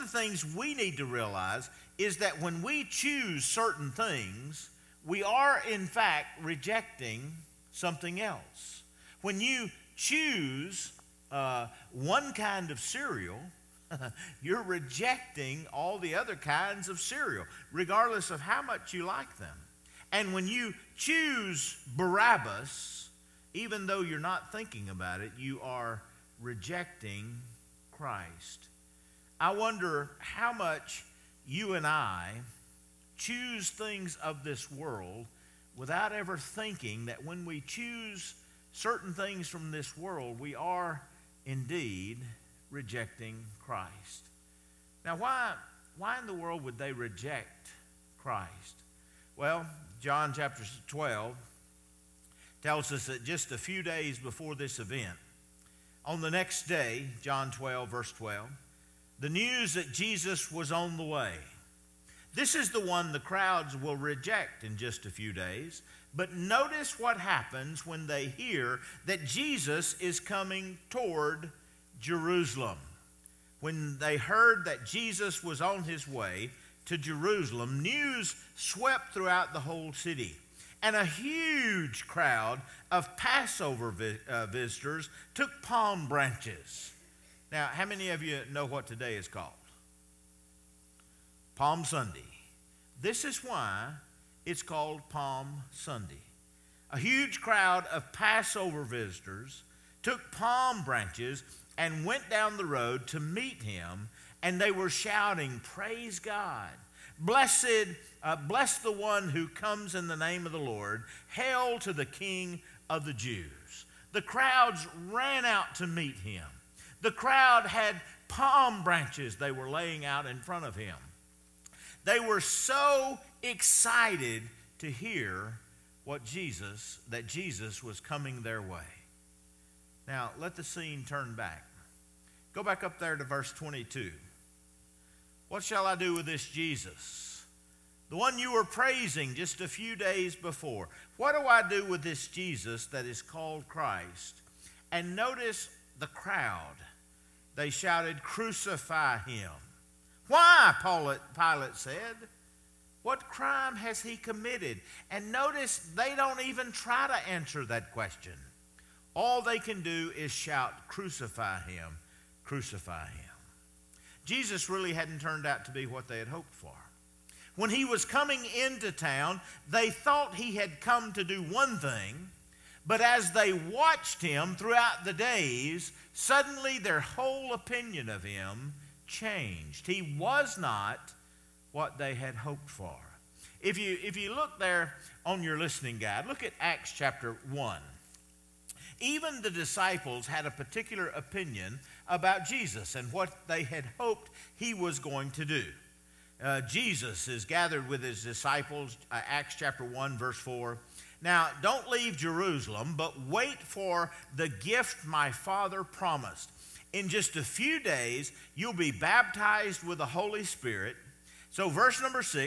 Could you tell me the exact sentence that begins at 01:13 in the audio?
When they heard that Jesus was on his way to Jerusalem, news swept throughout the whole city.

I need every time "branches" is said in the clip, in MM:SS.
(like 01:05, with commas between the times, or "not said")
01:26, 01:40, 01:58.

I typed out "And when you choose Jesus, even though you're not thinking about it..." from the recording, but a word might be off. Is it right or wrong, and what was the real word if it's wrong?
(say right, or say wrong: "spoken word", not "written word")
wrong: "Barabbas", not "Jesus".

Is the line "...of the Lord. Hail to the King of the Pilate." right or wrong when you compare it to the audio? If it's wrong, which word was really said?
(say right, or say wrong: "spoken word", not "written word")
wrong: "Jews", not "Pilate".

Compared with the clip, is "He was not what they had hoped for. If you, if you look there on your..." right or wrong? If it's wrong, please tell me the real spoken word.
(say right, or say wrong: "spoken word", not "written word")
right.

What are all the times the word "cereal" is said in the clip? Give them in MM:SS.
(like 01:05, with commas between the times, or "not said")
00:12, 00:16.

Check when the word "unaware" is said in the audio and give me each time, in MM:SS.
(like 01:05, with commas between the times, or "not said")
not said.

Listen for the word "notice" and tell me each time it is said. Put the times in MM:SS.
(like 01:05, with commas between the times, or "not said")
01:06, 02:25, 02:35.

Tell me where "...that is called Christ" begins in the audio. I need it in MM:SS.
02:22.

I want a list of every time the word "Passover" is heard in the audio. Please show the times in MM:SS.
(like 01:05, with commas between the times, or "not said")
01:23, 01:38.